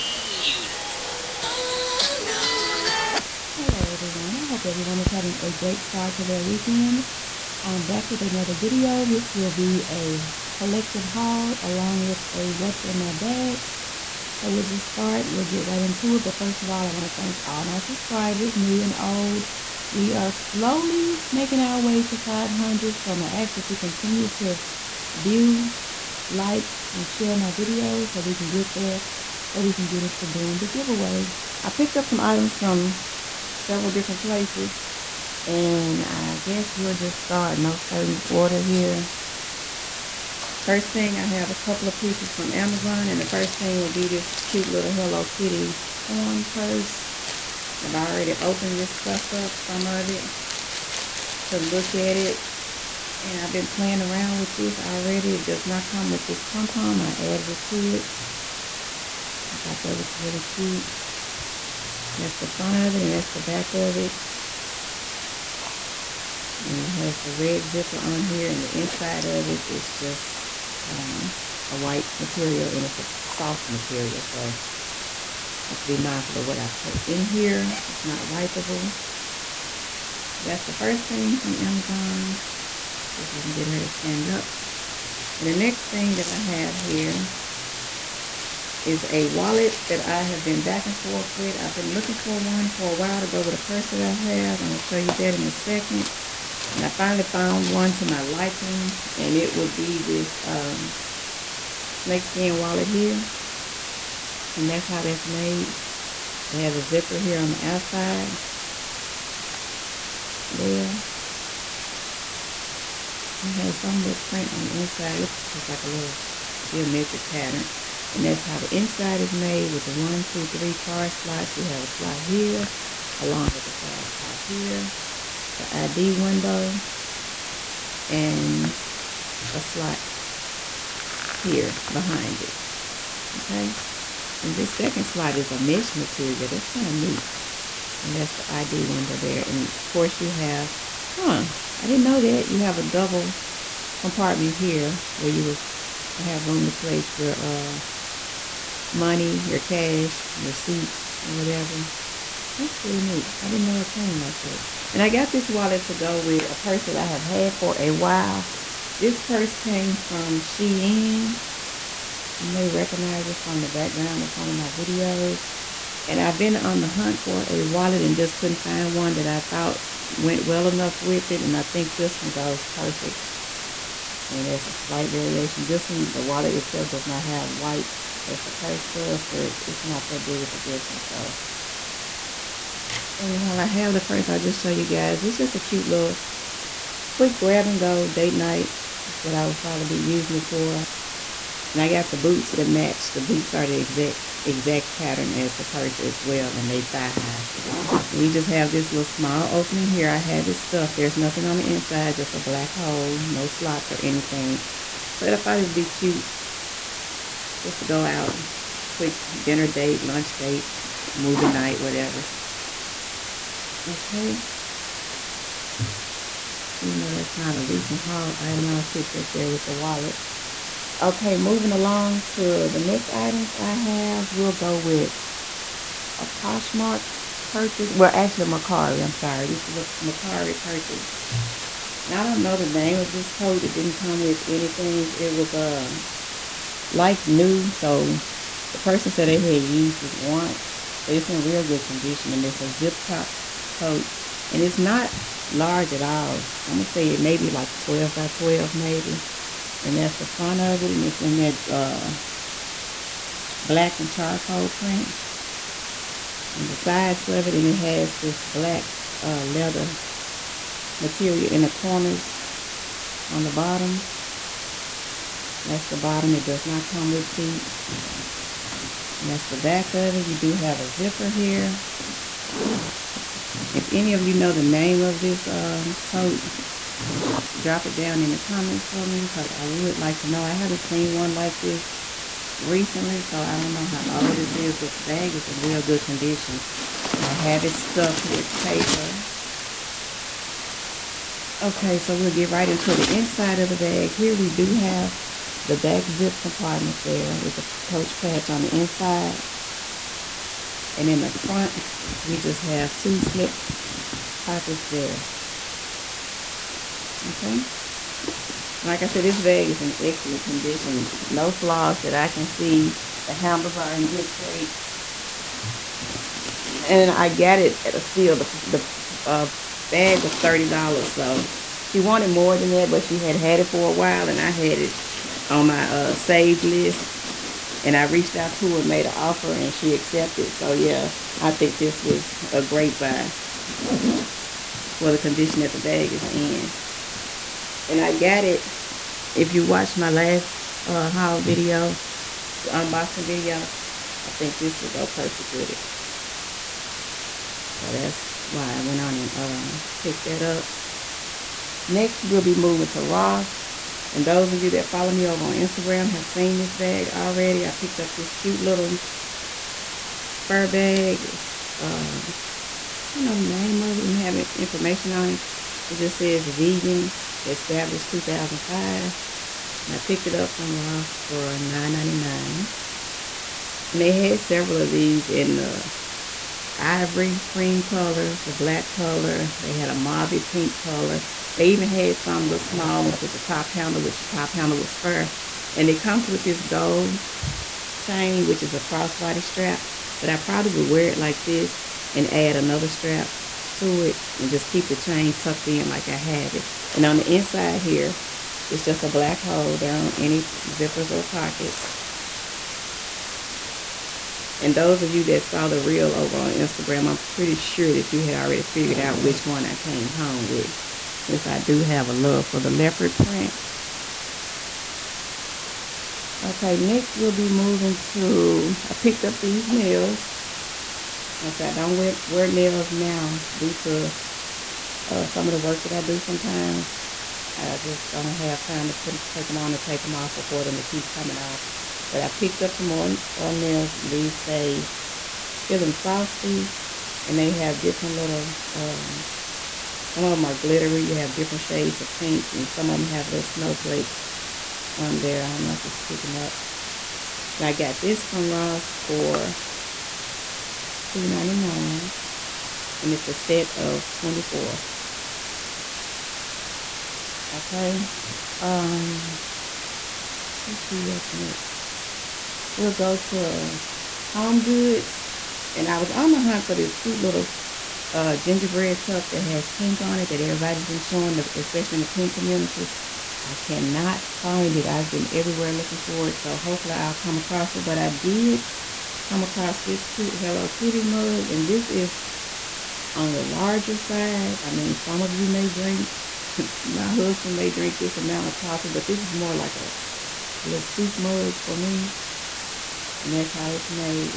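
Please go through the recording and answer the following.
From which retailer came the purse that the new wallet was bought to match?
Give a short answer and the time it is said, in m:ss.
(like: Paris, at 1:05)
Shein, at 2:40.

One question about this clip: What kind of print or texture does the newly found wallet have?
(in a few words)
snakeskin.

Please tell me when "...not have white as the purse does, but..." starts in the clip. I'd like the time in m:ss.
2:57.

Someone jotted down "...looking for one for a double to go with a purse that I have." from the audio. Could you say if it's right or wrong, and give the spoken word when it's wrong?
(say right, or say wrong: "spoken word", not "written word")
wrong: "while", not "double".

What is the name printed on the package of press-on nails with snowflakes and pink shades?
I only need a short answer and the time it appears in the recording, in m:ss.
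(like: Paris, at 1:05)
Feeling Frosty, at 7:15.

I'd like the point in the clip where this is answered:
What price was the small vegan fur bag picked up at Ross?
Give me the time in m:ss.
6:11.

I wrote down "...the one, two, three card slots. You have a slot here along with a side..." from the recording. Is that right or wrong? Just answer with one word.
right.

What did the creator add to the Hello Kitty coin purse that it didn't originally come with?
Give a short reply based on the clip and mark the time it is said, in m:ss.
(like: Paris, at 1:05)
pom-pom, at 0:56.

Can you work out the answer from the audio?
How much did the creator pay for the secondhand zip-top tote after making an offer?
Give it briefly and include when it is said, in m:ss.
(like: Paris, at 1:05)
$30, at 5:20.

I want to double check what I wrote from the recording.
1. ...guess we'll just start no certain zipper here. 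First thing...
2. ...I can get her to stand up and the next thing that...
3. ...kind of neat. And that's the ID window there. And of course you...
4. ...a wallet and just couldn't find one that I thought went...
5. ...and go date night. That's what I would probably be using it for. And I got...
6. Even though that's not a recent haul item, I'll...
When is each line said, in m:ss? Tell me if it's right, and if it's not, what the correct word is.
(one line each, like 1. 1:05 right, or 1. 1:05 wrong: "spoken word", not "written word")
1. 0:36 wrong: "order", not "zipper"
2. 1:23 right
3. 2:16 right
4. 2:47 right
5. 3:07 right
6. 3:36 right.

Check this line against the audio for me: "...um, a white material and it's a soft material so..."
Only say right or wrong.
right.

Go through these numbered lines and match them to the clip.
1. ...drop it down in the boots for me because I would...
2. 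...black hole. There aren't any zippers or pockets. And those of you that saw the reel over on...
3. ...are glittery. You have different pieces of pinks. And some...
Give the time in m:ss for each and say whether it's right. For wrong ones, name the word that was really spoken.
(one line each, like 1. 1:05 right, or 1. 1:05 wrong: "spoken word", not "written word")
1. 4:37 wrong: "comments", not "boots"
2. 6:39 right
3. 7:20 wrong: "shades", not "pieces".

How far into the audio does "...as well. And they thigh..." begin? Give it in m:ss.
3:15.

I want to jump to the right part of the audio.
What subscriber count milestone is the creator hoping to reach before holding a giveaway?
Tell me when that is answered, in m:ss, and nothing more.
0:22.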